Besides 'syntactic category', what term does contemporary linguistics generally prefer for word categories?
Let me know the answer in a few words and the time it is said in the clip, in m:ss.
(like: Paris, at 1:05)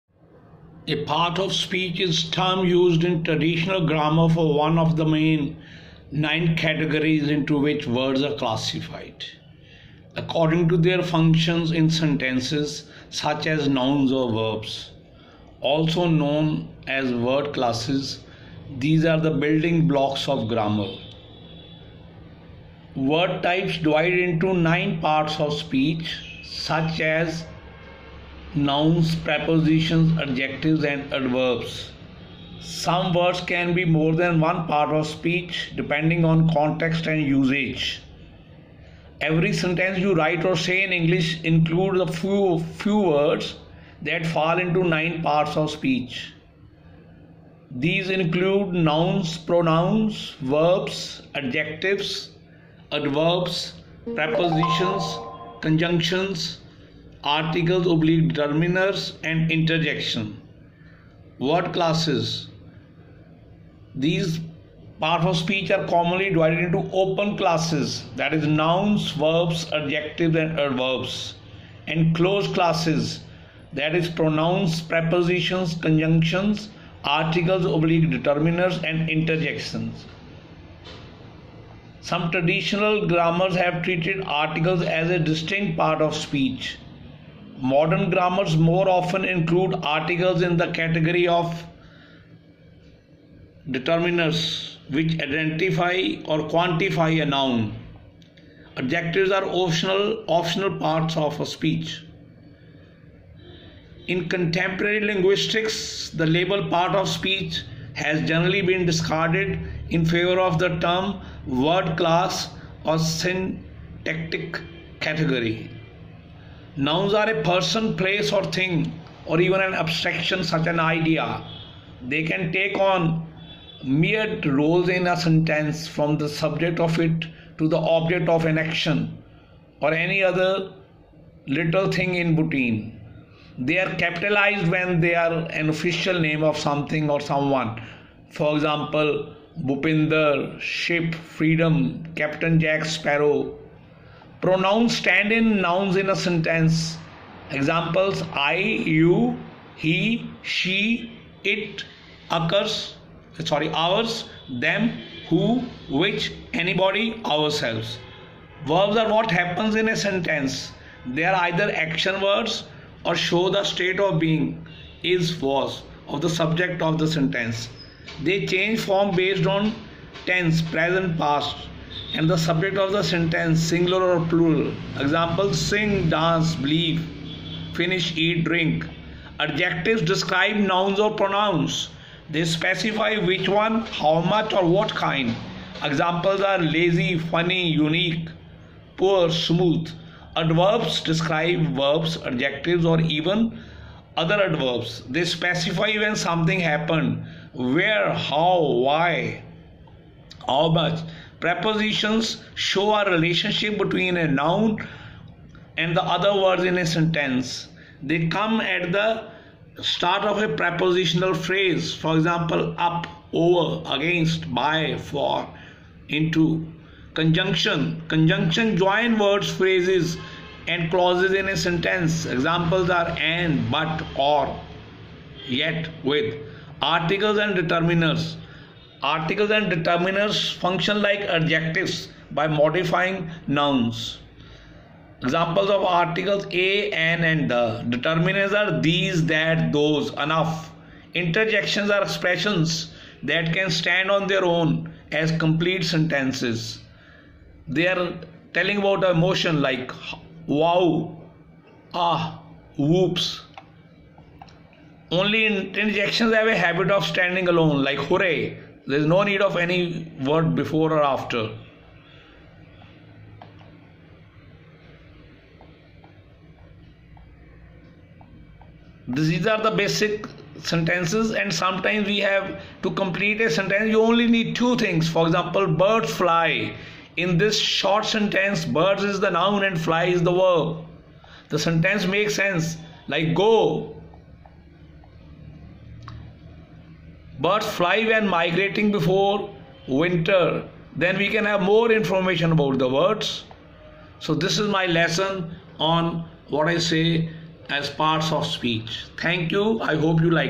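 word class, at 1:51.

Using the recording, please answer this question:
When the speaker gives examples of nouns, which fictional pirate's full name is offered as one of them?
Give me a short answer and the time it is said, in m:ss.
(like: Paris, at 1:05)
Captain Jack Sparrow, at 2:22.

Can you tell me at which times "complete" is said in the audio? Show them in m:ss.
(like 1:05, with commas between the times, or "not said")
4:05, 4:32.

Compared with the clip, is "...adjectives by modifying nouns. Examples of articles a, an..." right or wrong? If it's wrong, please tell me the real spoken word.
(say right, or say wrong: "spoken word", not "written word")
right.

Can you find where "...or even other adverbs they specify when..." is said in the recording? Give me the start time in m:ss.
3:12.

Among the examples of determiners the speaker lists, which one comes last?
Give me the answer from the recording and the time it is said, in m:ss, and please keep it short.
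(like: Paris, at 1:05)
enough, at 4:00.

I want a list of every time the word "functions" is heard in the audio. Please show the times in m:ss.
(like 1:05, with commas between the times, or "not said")
0:11, 3:50.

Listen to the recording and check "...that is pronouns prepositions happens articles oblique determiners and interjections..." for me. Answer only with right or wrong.
wrong.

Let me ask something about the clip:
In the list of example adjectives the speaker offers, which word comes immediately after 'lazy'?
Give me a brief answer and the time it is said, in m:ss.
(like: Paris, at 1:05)
funny, at 3:07.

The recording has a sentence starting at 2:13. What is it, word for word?
They are capitalized when they are an official name of something or someone.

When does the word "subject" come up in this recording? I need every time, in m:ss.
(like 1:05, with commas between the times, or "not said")
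2:06, 2:46, 2:52.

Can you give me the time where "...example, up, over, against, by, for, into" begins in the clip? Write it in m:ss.
3:32.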